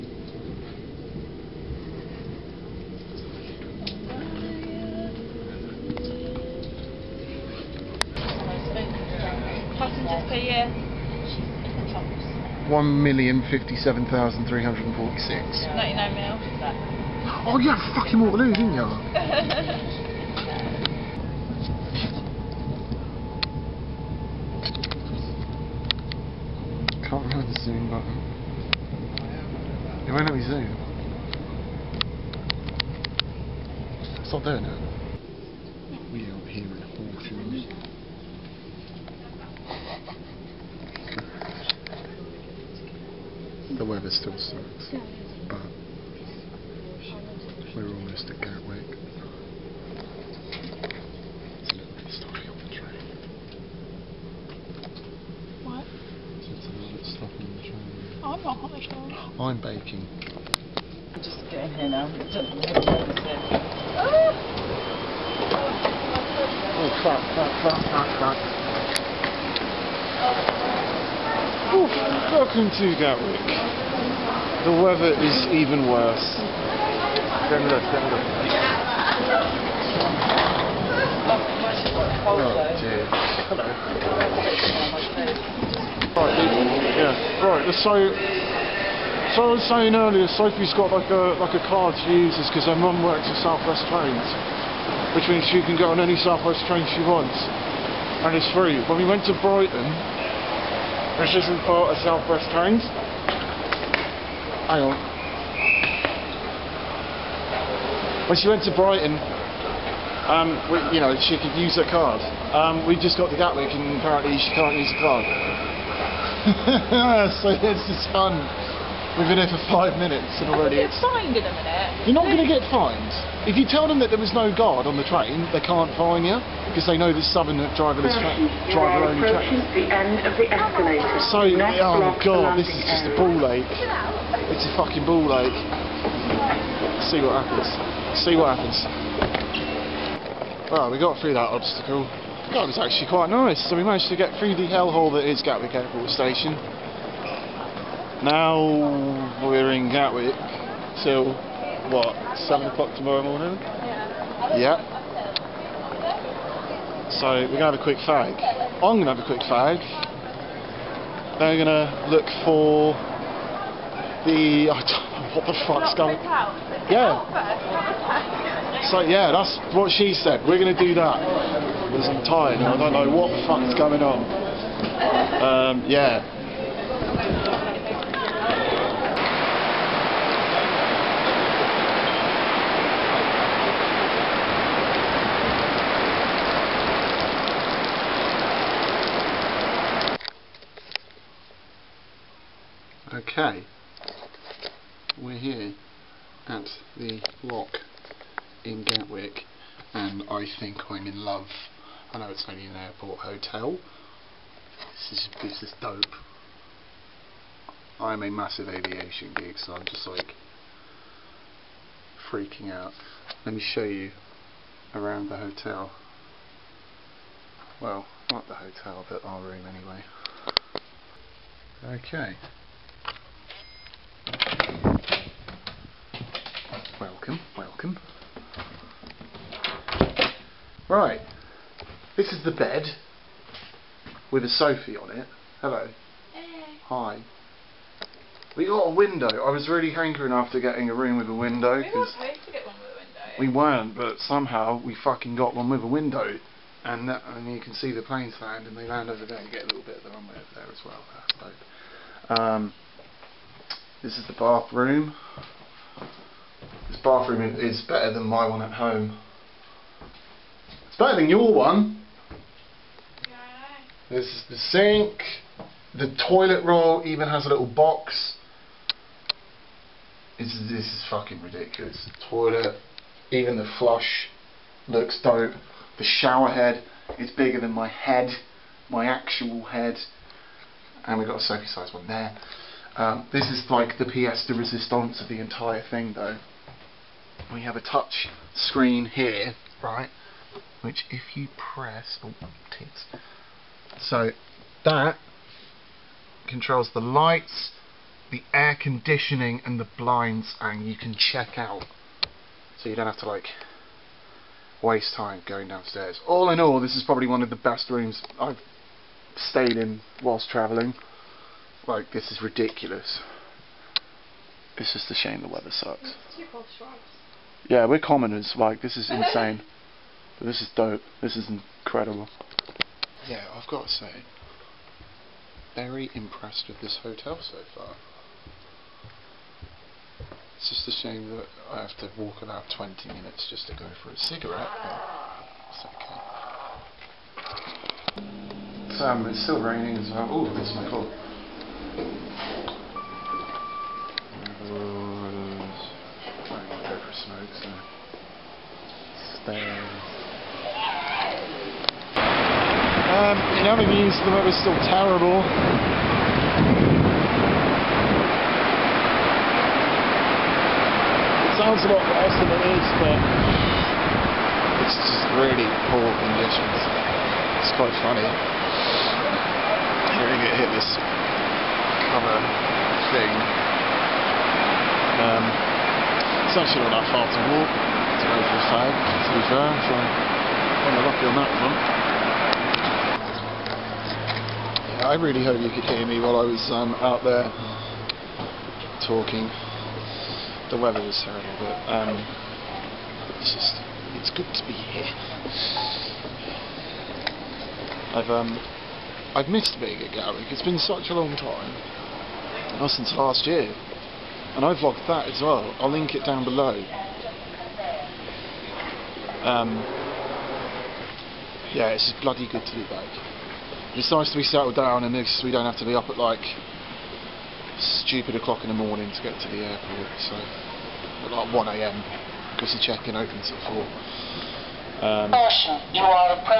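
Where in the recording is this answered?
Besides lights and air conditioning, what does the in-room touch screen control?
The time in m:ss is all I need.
4:59.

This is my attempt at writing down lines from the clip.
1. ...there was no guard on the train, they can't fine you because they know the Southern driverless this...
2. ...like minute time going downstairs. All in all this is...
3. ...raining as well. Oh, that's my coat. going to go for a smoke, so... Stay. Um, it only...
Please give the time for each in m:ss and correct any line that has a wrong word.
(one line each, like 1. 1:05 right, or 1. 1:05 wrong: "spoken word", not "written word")
1. 2:04 right
2. 5:03 wrong: "waste", not "minute"
3. 5:39 right.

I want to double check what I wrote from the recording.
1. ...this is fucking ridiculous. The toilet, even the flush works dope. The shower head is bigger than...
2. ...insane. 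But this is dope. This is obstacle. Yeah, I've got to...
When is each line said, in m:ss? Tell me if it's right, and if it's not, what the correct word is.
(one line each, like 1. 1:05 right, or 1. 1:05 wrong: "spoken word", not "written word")
1. 4:30 wrong: "looks", not "works"
2. 5:19 wrong: "incredible", not "obstacle".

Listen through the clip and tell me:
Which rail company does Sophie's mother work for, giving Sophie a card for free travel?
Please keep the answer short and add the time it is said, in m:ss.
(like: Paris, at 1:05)
Southwest Trains, at 1:33.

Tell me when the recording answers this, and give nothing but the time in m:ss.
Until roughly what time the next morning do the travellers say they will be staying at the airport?
2:32.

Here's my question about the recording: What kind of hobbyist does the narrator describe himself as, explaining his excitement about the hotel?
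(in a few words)
aviation geek.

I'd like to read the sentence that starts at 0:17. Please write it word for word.
Oh, you had fucking Waterloo, didn't you?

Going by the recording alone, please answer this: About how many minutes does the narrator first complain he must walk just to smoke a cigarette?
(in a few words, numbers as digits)
20 minutes.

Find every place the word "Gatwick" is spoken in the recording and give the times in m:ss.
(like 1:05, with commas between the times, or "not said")
0:48, 1:12, 1:53, 2:25, 2:29, 6:40.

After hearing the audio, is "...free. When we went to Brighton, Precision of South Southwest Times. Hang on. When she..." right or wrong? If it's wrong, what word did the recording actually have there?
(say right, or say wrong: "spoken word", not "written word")
right.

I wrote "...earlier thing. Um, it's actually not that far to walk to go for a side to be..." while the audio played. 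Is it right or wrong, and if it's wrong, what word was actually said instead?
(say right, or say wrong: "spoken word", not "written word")
wrong: "cover", not "earlier".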